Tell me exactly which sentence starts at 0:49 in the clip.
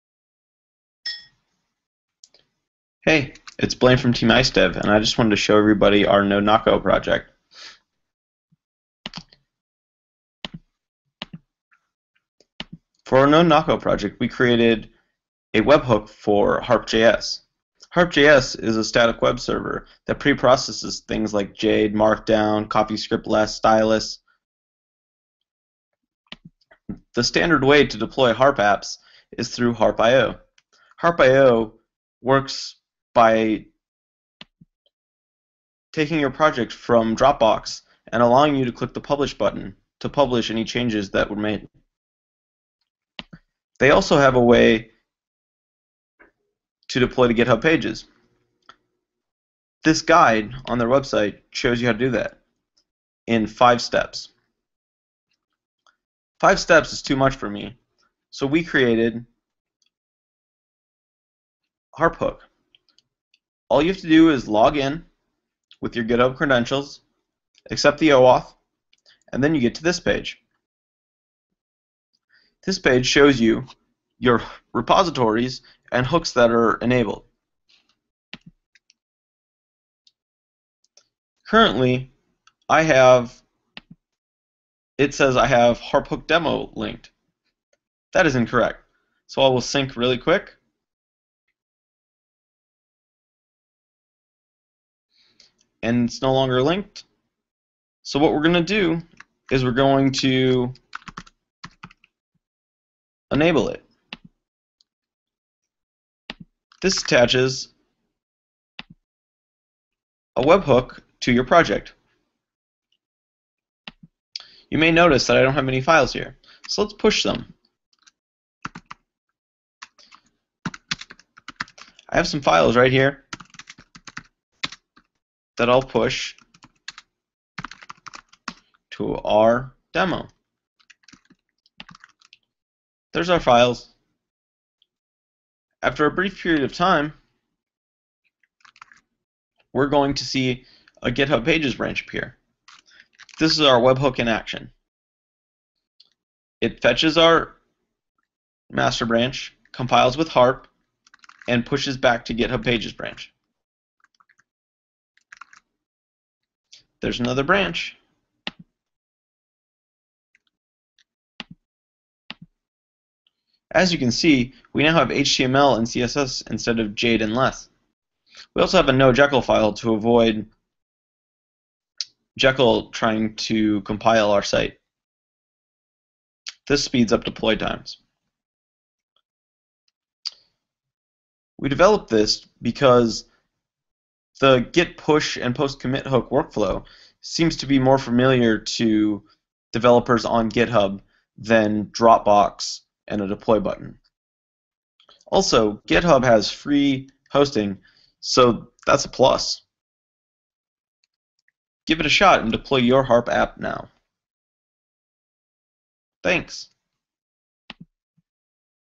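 This guide on their website shows you how to do that in five steps.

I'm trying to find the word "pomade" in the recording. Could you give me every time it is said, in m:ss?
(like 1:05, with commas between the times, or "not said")
not said.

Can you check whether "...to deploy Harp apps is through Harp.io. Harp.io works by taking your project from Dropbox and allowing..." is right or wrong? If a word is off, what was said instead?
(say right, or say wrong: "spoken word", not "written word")
right.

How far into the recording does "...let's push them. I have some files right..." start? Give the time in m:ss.
1:56.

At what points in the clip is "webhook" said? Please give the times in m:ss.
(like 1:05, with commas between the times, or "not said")
0:15, 1:50, 2:23.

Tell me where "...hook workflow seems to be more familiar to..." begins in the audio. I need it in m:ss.
3:06.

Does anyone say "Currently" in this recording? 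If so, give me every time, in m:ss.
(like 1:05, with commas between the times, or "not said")
1:21.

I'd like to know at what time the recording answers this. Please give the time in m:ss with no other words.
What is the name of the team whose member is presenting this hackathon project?
0:04.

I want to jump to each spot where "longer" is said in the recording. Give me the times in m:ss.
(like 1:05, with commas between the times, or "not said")
1:36.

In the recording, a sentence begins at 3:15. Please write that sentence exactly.
Also, GitHub has free hosting, so that's a plus.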